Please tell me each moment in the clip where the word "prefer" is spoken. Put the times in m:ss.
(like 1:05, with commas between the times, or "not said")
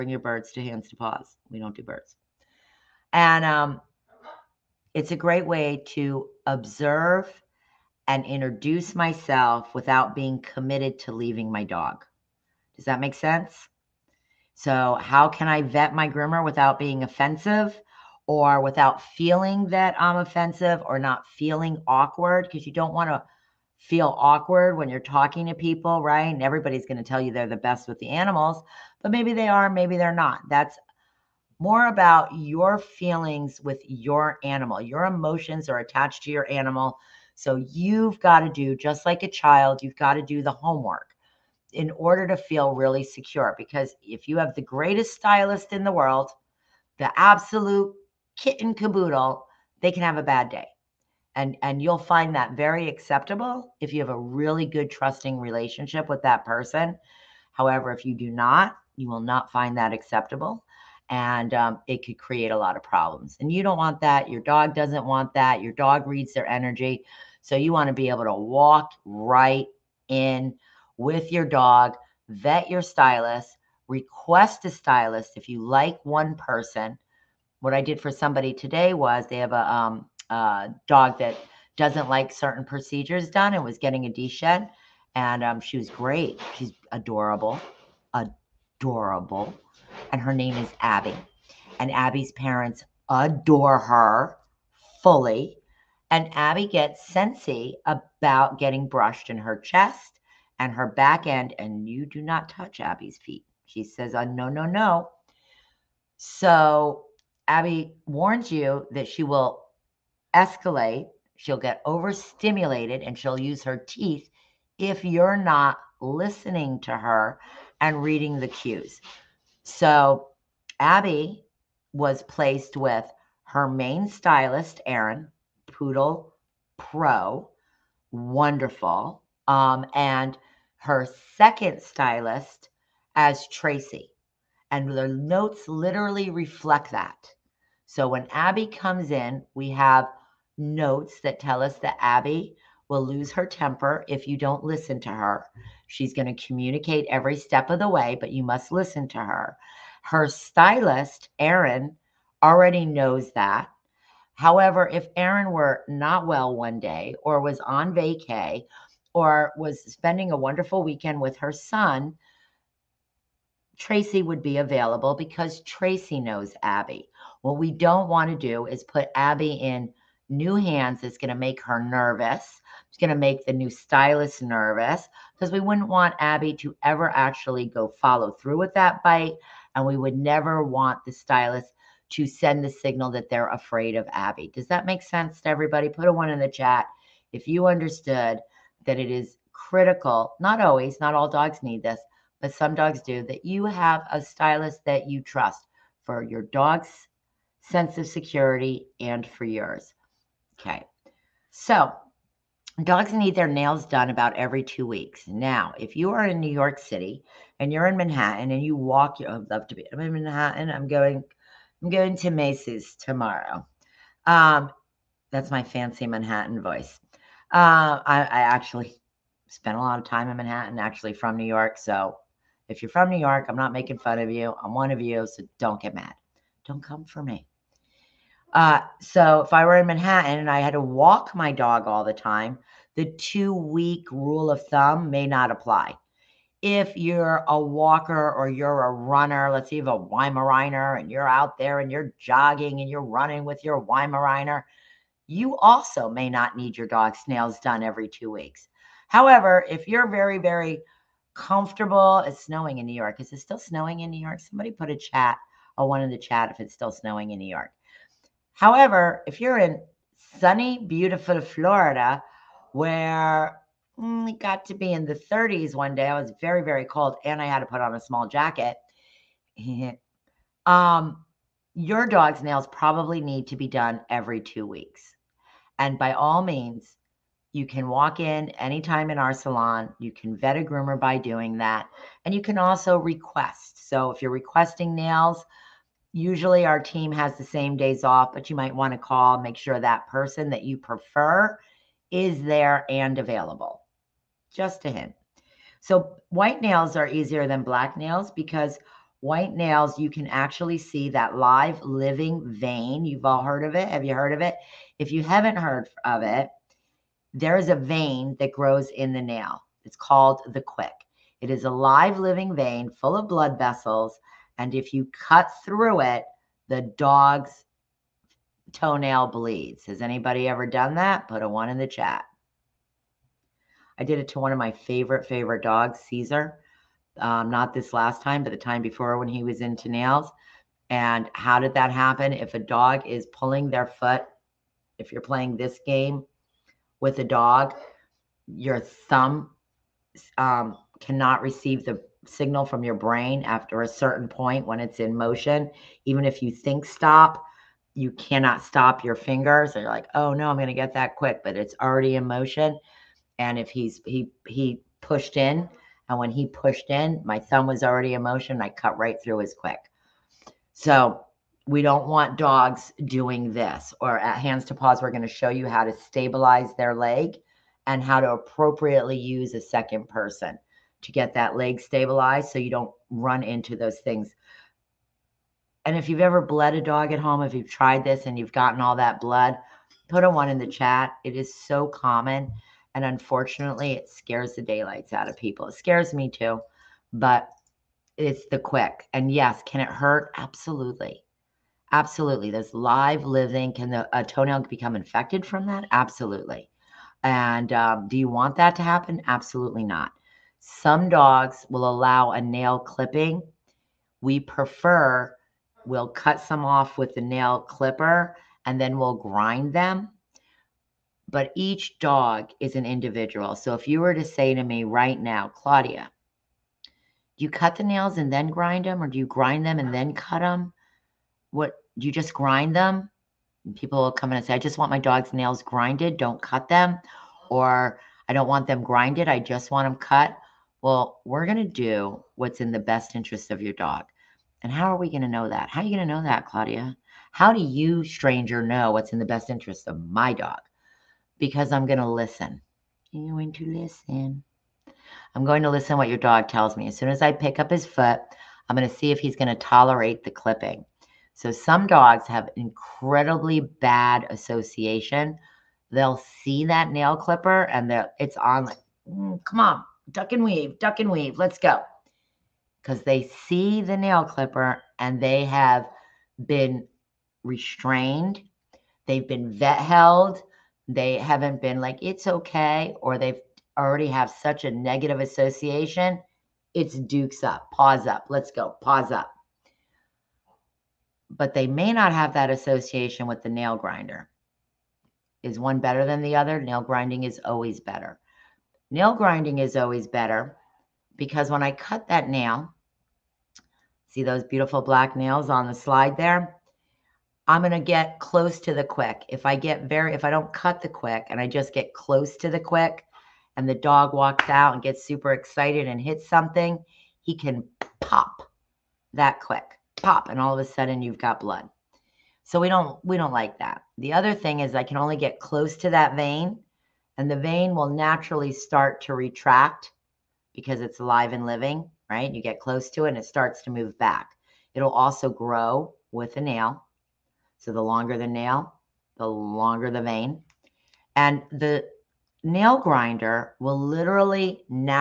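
4:50, 6:44.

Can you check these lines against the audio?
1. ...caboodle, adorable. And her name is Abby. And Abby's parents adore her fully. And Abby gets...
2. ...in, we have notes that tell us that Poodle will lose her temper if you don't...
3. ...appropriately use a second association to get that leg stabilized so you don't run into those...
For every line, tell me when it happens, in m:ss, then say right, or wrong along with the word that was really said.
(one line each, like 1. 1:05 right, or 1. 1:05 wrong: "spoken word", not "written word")
1. 1:26 wrong: "adorable", not "caboodle"
2. 2:19 wrong: "Abby", not "Poodle"
3. 6:08 wrong: "person", not "association".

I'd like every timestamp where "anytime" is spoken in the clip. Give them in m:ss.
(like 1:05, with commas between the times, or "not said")
4:38.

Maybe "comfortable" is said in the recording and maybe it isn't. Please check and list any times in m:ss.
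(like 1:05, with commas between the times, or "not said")
4:11.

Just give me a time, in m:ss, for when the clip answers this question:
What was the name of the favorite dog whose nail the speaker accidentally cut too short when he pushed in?
5:25.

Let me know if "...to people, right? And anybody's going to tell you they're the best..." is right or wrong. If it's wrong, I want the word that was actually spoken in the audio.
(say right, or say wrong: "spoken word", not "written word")
wrong: "everybody", not "anybody".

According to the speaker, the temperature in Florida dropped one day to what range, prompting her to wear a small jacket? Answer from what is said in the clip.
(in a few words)
the 30s.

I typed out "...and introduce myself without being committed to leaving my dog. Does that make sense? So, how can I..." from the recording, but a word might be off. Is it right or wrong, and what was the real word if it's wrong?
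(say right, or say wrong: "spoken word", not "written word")
right.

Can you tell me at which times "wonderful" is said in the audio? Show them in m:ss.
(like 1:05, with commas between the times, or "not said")
2:08, 2:40.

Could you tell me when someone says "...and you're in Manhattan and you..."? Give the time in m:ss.
3:27.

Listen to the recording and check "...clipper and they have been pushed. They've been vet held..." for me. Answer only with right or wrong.
wrong.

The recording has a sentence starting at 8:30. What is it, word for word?
And all of a sudden you've got blood.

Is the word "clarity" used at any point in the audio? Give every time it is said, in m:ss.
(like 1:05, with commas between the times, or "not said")
not said.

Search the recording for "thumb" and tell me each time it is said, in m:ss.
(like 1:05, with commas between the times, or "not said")
3:54, 5:38, 5:57.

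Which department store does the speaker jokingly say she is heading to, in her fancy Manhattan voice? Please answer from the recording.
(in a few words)
Macy's.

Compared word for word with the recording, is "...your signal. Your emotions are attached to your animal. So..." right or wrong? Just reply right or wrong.
wrong.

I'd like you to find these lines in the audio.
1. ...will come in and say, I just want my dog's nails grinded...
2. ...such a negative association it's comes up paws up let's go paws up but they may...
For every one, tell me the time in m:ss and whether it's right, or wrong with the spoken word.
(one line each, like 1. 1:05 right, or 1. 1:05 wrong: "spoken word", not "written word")
1. 7:04 right
2. 7:54 wrong: "dukes", not "comes".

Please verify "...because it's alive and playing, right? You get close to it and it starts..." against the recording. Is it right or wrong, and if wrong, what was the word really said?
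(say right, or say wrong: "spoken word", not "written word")
wrong: "living", not "playing".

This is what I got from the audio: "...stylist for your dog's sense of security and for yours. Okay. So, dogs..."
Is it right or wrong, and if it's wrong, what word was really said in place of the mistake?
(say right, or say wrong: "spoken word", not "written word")
wrong: "trust", not "stylist".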